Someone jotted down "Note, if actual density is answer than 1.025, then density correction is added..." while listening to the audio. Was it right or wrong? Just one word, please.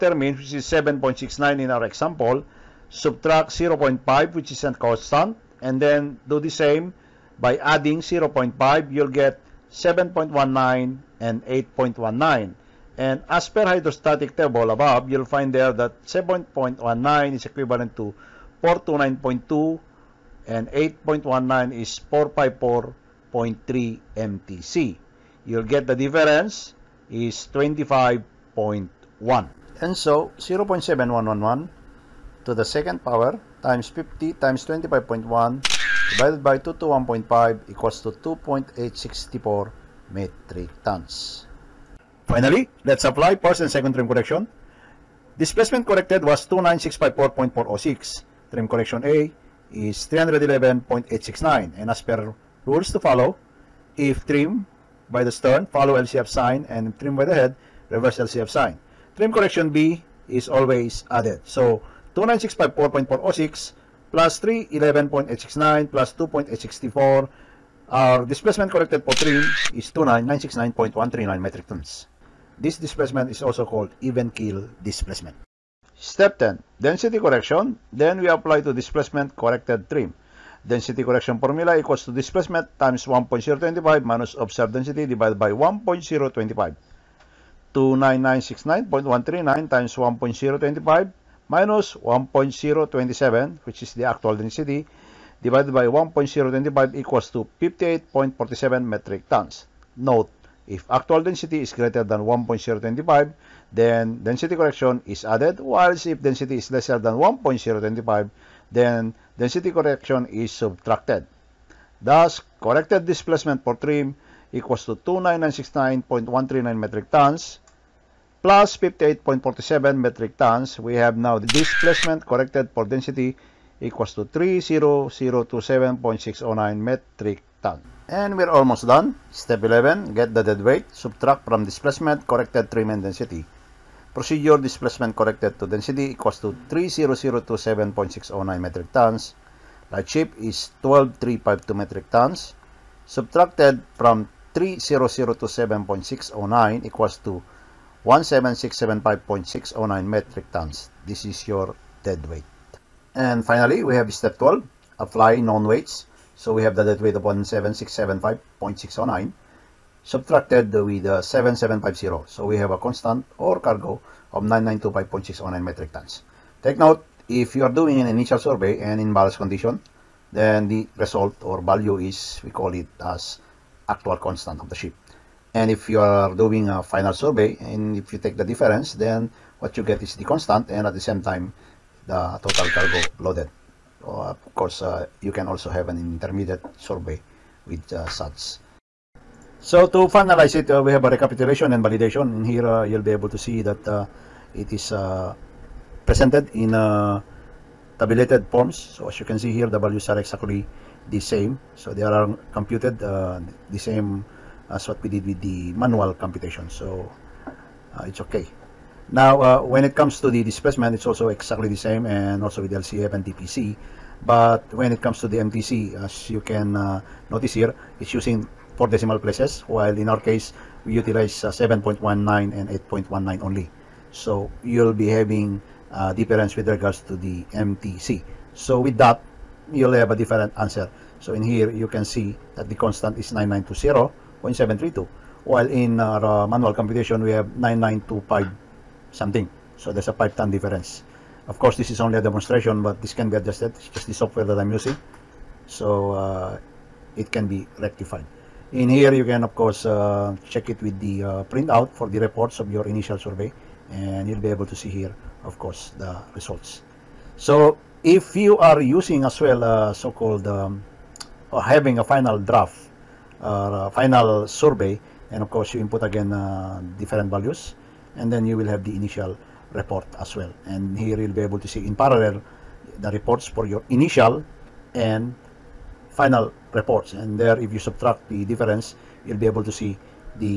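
wrong.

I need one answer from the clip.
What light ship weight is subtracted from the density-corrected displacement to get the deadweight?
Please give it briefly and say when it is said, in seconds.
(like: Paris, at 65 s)
12352 metric tons, at 140 s.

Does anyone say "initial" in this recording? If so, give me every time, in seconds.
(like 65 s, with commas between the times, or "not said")
168 s, 252 s, 268 s, 273 s.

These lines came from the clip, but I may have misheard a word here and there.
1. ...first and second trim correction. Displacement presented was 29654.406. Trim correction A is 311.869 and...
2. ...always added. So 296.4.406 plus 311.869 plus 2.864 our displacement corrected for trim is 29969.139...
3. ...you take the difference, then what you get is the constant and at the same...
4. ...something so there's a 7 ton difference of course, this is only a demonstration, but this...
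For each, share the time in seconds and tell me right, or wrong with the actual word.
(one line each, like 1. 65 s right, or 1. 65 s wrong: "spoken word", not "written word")
1. 43 s wrong: "corrected", not "presented"
2. 60 s right
3. 178 s right
4. 239 s wrong: "5", not "7".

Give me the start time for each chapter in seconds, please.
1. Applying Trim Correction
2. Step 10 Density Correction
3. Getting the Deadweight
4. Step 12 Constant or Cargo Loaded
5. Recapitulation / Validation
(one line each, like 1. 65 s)
1. 41 s
2. 75 s
3. 128 s
4. 154 s
5. 188 s.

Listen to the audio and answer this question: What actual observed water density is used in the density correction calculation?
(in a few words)
1.027.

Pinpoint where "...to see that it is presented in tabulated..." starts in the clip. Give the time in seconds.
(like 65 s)
193 s.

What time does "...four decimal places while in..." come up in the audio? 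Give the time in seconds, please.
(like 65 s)
218 s.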